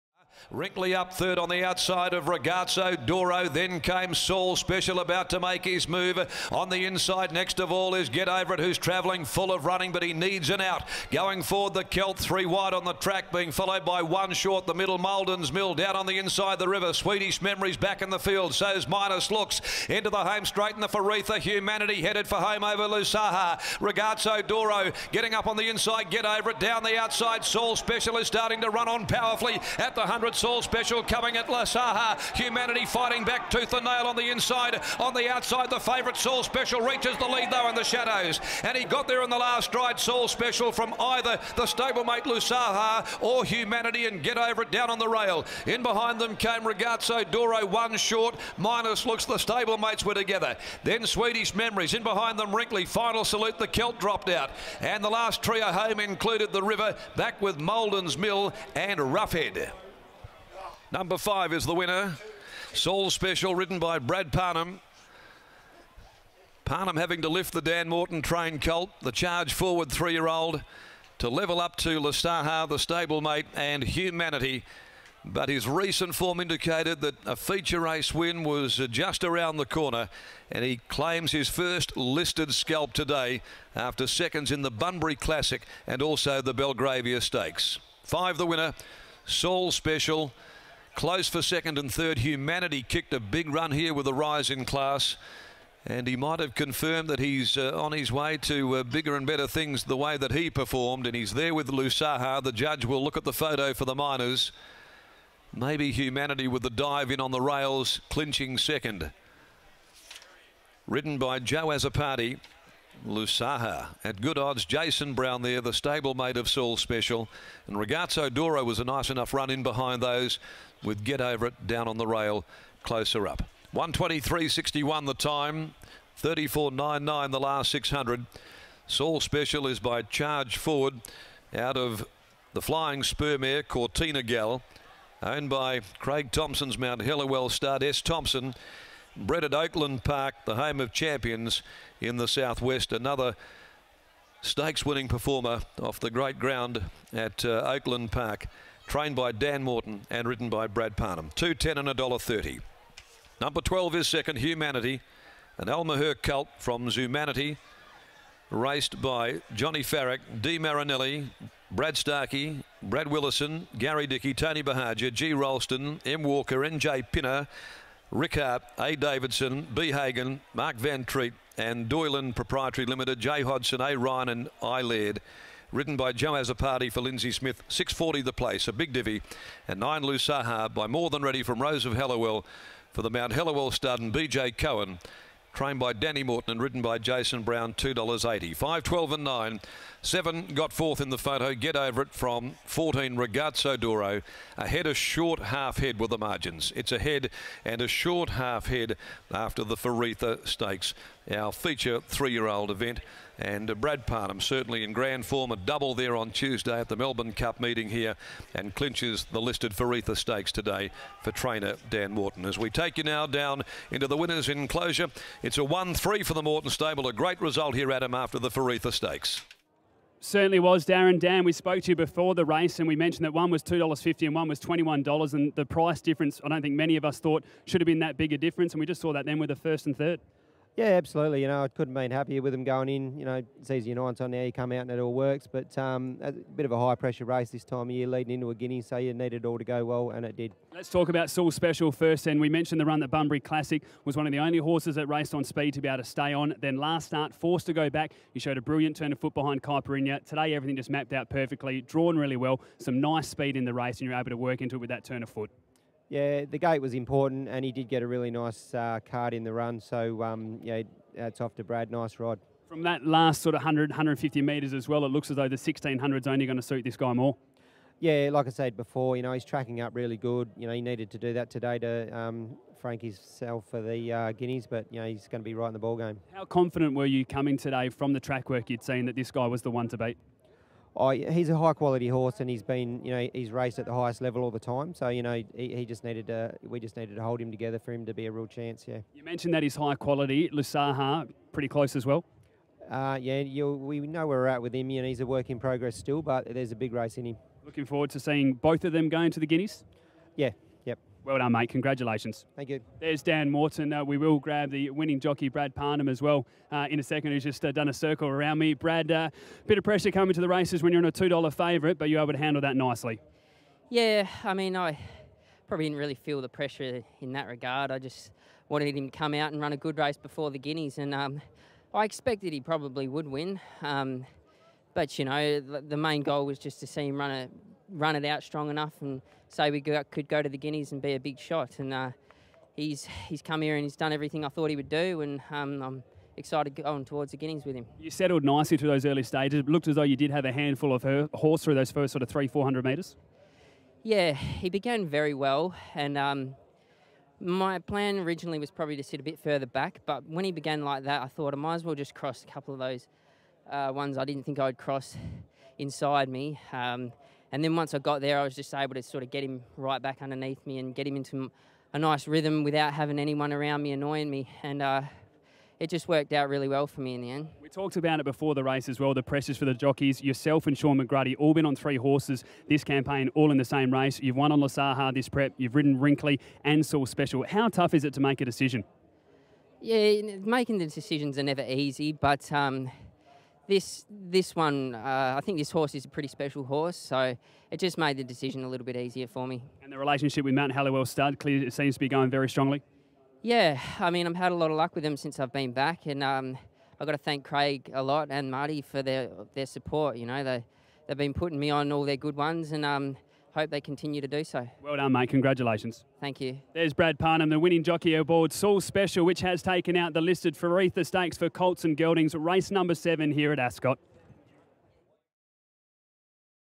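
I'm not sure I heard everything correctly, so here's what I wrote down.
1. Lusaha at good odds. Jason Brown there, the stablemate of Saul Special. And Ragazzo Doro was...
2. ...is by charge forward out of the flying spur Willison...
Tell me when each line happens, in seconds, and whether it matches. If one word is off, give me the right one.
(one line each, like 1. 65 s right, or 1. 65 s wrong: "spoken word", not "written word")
1. 113 s right
2. 129 s wrong: "Cortina", not "Willison".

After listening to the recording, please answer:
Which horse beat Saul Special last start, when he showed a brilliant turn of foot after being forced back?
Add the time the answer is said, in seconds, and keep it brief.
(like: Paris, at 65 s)
Kai Perinia, at 249 s.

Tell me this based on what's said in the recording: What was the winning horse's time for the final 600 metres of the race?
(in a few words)
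34.99.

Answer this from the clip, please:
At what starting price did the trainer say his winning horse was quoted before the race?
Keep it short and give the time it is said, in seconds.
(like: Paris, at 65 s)
$2.50, at 223 s.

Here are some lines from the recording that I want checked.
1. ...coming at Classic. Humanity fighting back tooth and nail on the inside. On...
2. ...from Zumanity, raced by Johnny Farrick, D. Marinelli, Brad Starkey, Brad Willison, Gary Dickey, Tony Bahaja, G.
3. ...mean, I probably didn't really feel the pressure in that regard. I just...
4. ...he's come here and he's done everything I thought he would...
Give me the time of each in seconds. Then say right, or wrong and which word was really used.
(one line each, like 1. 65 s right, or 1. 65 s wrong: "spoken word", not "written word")
1. 31 s wrong: "Lusaha", not "Classic"
2. 156 s right
3. 314 s right
4. 333 s right.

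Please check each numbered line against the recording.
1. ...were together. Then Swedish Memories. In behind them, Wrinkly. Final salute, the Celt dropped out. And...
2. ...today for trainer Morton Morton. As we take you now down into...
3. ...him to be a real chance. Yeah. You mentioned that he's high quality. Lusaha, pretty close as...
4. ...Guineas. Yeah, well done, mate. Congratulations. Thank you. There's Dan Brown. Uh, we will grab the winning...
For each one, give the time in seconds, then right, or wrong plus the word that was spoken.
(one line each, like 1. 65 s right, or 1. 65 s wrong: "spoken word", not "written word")
1. 50 s right
2. 210 s wrong: "Dan", not "Morton"
3. 287 s right
4. 299 s wrong: "Morton", not "Brown".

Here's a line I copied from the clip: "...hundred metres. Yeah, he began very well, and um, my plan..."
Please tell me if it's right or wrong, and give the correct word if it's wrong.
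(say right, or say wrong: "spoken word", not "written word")
right.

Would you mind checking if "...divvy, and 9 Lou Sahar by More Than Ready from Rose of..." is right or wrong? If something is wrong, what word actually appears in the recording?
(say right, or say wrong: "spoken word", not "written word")
right.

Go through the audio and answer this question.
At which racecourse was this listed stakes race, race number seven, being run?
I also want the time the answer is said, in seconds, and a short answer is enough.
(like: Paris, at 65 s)
Ascot, at 413 s.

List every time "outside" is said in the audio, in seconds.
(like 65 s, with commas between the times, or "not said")
1 s, 26 s, 35 s.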